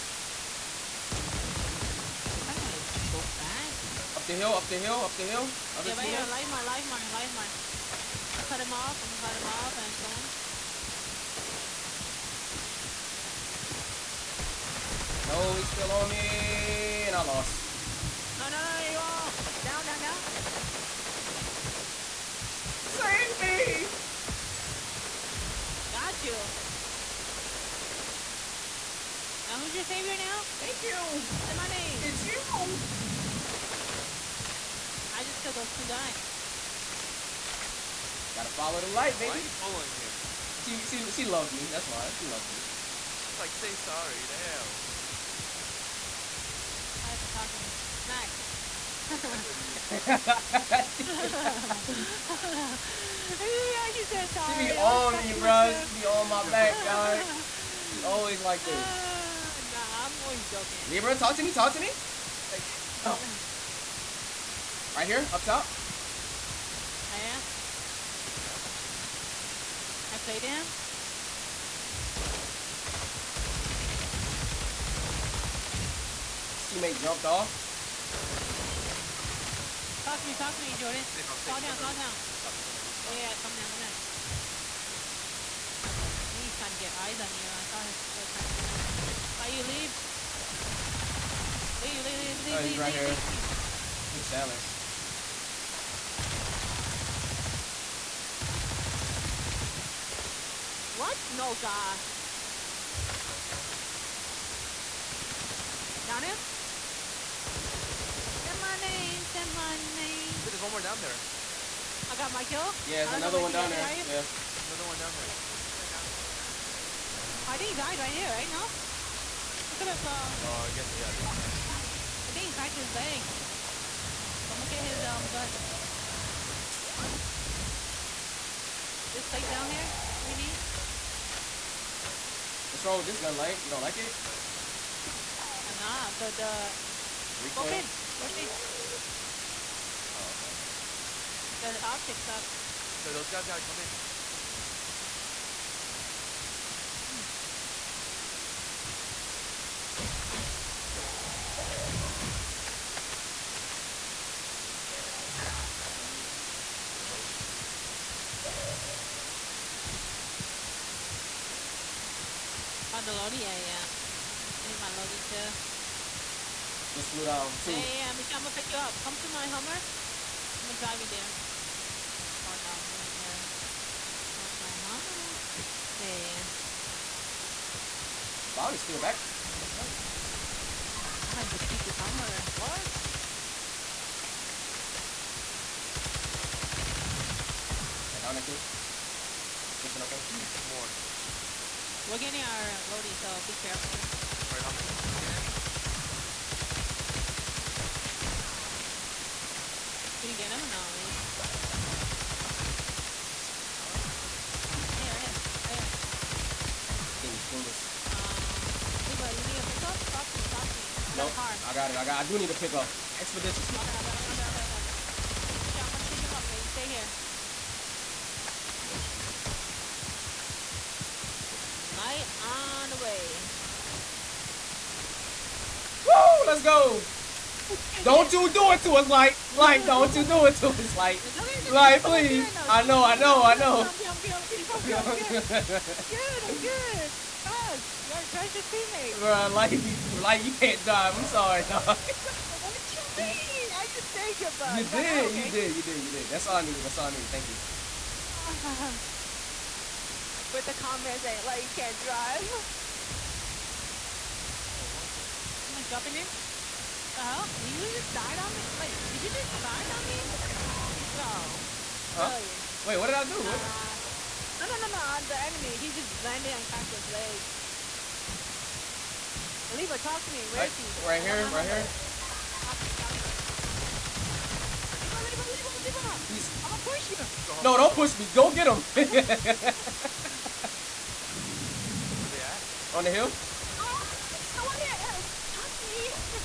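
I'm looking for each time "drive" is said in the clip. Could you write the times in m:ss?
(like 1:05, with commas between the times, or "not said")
2:50, 4:00, 4:11.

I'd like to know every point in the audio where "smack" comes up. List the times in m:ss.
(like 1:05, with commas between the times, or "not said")
0:47.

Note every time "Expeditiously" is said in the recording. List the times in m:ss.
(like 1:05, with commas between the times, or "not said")
3:33.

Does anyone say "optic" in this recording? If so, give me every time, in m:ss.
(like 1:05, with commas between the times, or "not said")
2:21.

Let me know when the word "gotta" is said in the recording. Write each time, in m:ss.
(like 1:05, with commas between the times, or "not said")
0:38, 2:23, 3:58.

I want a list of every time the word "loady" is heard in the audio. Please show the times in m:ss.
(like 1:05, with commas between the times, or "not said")
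3:12.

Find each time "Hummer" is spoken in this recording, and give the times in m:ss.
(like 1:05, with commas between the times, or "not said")
2:49, 2:54, 3:01.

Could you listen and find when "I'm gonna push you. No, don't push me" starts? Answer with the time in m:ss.
4:36.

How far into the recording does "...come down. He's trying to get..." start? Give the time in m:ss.
1:23.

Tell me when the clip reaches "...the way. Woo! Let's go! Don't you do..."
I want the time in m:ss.
3:42.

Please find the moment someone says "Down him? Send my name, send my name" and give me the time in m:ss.
1:46.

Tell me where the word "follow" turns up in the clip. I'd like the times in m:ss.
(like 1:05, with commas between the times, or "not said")
0:38.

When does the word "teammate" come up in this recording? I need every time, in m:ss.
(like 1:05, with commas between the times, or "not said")
1:16, 3:58.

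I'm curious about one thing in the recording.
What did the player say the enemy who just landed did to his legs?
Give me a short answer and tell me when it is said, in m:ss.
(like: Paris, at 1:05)
cracked his legs, at 4:26.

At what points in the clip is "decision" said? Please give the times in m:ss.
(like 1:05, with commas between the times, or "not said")
not said.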